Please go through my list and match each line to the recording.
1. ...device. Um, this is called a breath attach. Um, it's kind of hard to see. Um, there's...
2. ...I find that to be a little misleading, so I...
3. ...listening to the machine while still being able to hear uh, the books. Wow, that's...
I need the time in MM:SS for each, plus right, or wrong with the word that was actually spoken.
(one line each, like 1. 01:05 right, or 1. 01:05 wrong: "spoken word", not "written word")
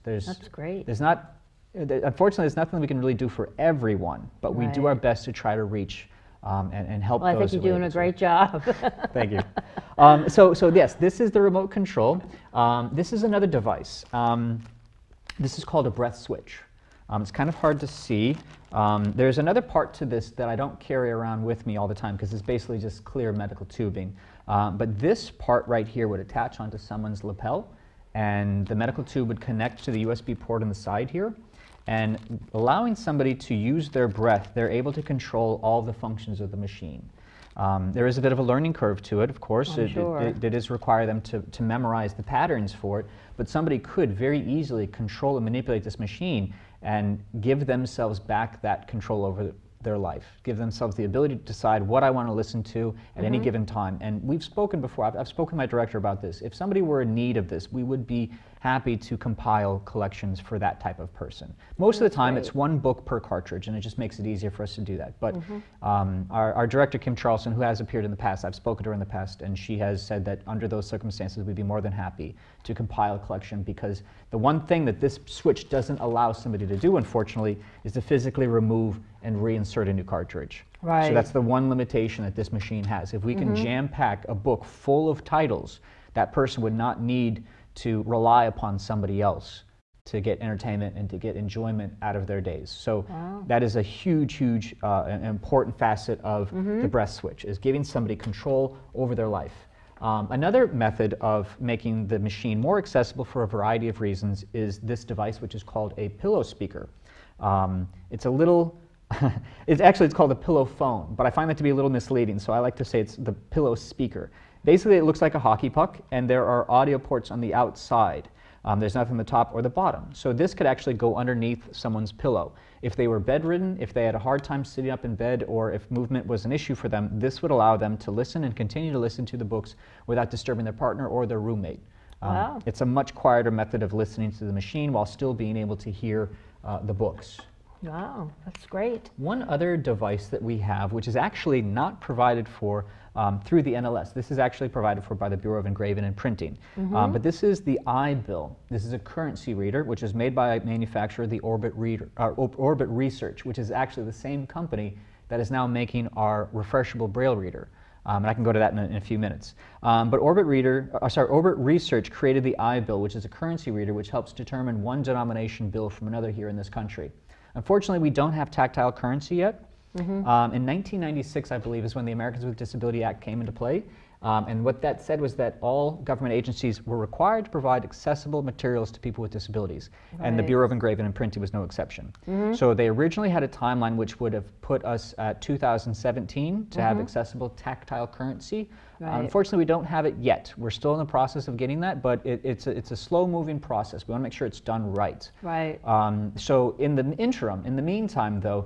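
1. 00:13 wrong: "switch", not "attach"
2. 01:51 right
3. 02:13 right.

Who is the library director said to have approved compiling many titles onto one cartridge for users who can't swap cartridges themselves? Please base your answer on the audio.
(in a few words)
Kim Charlson.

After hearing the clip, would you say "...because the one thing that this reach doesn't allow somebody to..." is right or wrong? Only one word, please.
wrong.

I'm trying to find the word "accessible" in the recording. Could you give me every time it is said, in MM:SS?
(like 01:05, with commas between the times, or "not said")
01:42, 02:57, 03:07.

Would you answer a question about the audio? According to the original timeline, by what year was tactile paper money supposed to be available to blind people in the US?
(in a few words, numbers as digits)
2017.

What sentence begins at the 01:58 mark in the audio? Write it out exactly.
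Um, there's nothing on the top or the bottom.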